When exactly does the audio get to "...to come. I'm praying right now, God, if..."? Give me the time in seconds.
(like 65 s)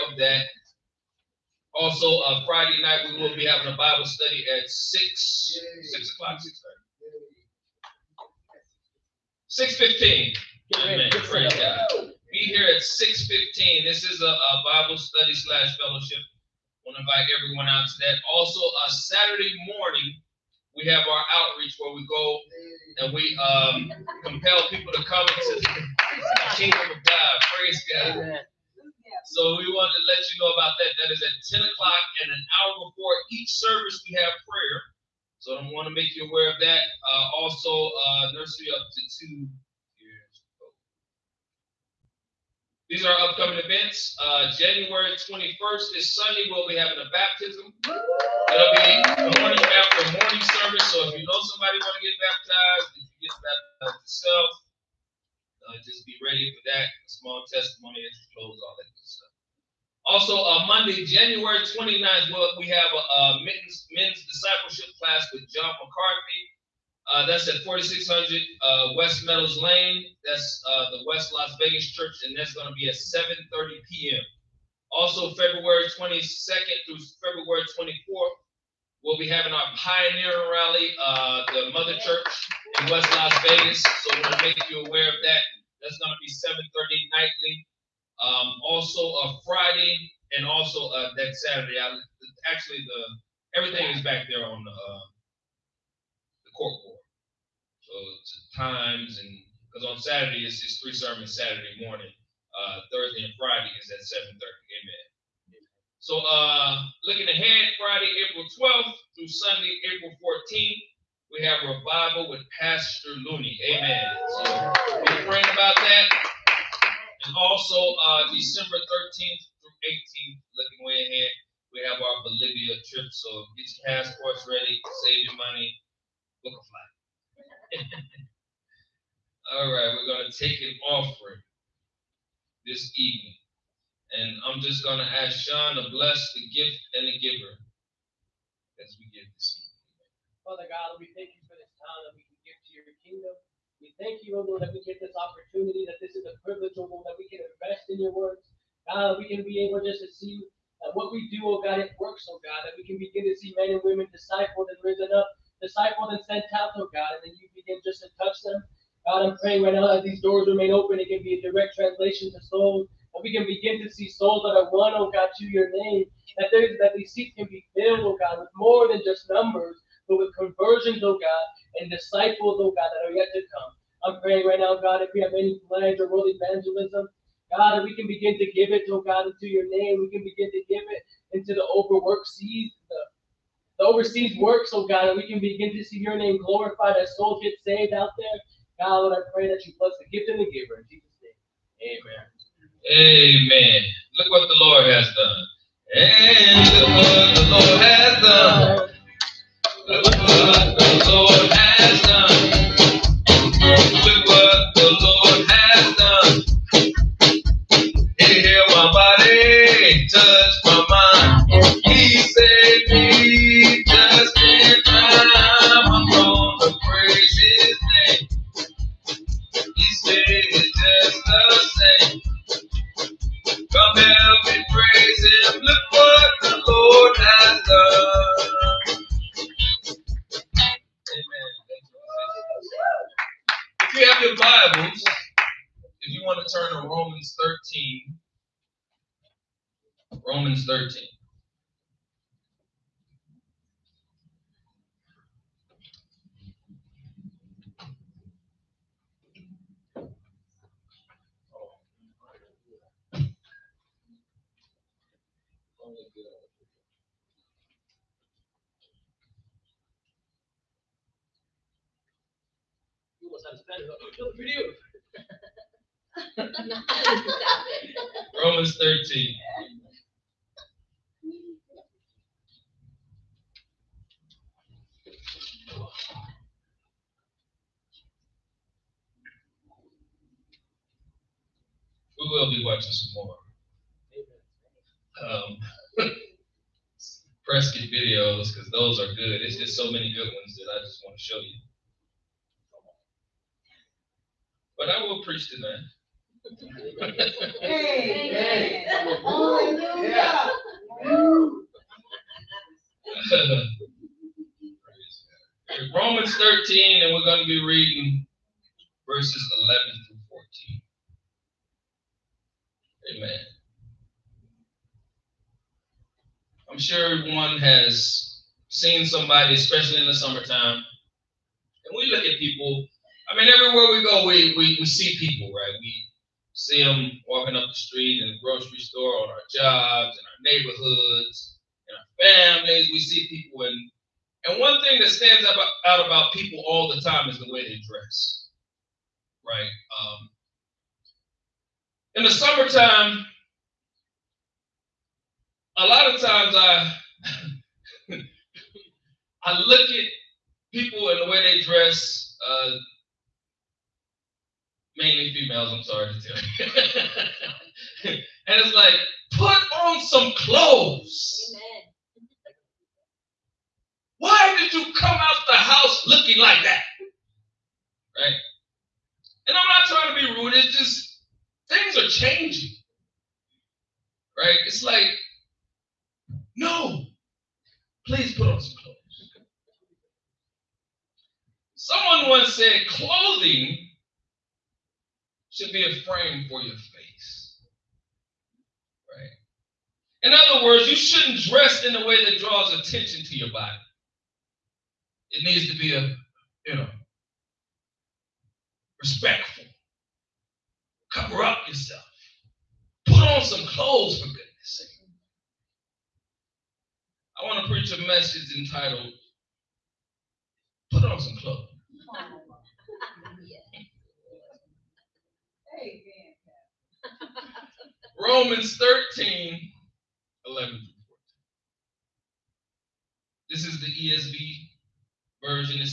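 173 s.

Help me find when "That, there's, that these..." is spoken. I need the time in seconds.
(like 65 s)
166 s.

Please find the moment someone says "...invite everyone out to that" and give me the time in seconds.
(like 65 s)
17 s.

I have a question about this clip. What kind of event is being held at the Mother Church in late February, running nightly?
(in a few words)
Pioneer rally.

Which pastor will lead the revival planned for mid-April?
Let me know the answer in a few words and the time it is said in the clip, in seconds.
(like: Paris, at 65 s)
Pastor Looney, at 112 s.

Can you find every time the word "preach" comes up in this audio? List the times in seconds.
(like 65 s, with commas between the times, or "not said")
295 s, 407 s.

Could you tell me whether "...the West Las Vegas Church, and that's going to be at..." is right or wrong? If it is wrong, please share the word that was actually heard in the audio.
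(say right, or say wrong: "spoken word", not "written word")
right.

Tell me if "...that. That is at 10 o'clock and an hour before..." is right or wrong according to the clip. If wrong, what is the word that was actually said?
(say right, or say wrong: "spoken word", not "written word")
right.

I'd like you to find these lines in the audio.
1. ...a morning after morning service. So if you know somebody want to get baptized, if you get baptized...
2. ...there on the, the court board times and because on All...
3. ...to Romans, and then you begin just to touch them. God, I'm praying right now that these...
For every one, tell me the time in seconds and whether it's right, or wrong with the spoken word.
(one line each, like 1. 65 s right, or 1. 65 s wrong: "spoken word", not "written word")
1. 49 s right
2. 94 s wrong: "Saturday", not "All"
3. 156 s wrong: "God", not "Romans".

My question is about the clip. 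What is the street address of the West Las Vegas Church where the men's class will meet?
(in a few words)
4600 West Meadows Lane.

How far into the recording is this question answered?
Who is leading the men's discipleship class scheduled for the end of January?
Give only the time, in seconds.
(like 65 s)
65 s.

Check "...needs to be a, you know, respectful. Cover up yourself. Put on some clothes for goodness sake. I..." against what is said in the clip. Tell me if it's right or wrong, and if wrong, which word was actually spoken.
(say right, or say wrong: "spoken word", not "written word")
right.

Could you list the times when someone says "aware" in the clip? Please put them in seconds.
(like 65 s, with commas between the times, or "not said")
36 s, 84 s.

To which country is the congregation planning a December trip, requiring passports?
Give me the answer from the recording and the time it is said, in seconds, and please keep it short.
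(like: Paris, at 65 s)
Bolivia, at 122 s.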